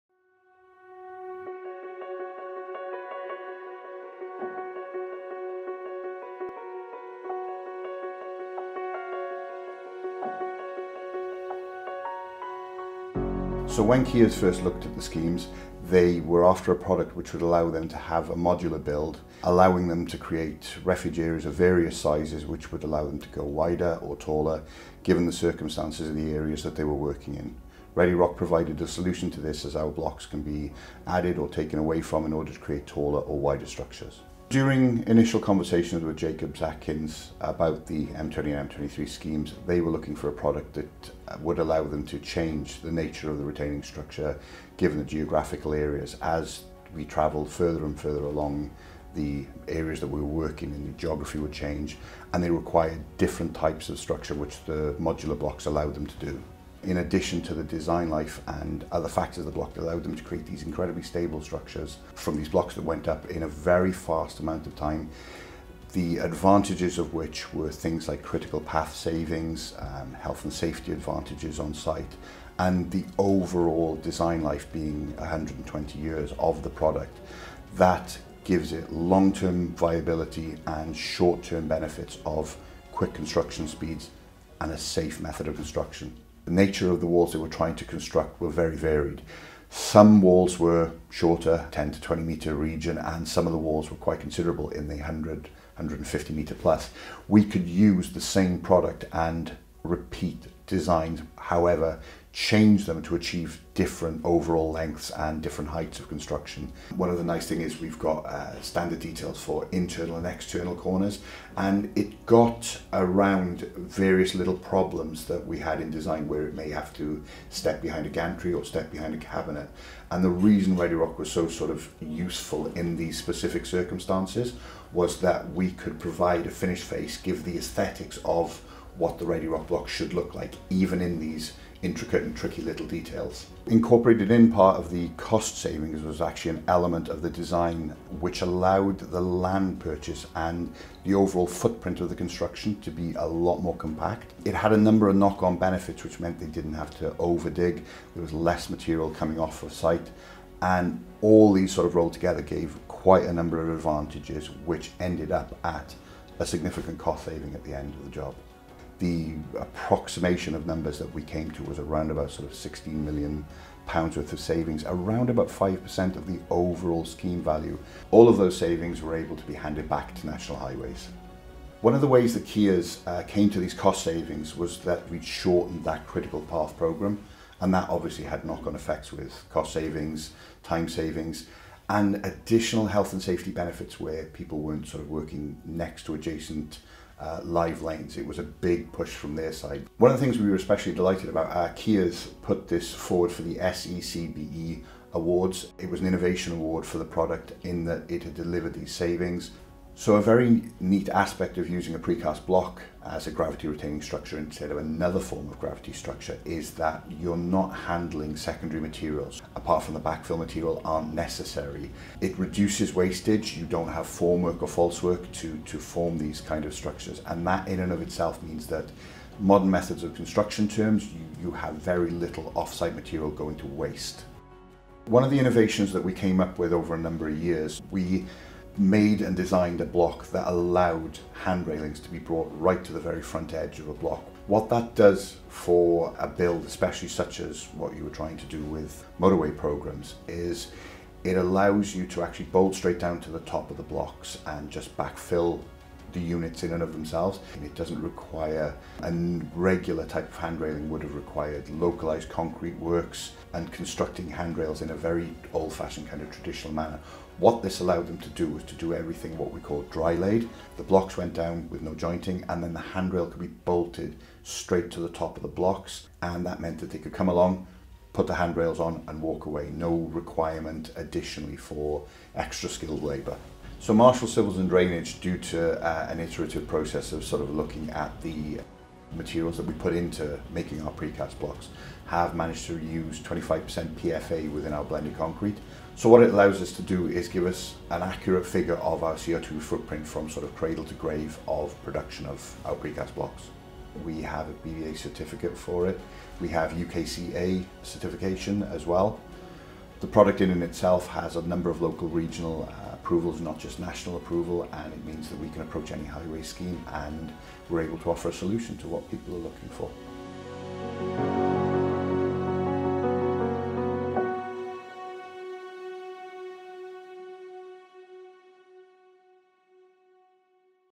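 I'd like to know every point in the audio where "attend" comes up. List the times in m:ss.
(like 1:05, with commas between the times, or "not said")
not said.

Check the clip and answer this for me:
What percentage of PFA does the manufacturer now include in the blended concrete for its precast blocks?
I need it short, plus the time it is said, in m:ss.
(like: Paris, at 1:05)
25%, at 4:43.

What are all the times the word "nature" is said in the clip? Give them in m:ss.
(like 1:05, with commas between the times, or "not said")
0:42, 1:26.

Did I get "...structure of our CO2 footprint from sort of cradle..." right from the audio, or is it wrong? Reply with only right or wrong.
wrong.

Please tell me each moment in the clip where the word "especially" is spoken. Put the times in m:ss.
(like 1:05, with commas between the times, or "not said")
3:10, 3:56.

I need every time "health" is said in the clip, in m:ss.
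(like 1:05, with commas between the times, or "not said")
1:10, 3:02.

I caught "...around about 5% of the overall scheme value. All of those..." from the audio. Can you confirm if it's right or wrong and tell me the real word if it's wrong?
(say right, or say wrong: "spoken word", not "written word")
right.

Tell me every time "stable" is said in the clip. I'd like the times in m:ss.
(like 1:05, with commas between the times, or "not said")
1:01.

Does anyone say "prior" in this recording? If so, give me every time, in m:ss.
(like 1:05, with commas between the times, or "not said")
not said.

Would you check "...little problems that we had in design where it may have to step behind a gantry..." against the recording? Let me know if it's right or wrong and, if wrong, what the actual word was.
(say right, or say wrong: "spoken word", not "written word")
right.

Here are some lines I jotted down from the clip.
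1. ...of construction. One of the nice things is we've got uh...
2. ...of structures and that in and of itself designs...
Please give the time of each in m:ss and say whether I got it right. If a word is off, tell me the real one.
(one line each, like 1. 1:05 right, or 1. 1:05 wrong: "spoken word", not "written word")
1. 1:45 right
2. 3:36 wrong: "means", not "designs".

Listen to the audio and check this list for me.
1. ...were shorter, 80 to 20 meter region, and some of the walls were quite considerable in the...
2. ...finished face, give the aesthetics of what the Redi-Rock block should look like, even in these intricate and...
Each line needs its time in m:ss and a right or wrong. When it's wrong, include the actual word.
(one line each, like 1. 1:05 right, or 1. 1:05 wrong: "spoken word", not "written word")
1. 1:30 wrong: "10", not "80"
2. 2:06 right.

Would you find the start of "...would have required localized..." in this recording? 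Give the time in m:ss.
4:10.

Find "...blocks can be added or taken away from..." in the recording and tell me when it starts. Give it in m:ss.
0:29.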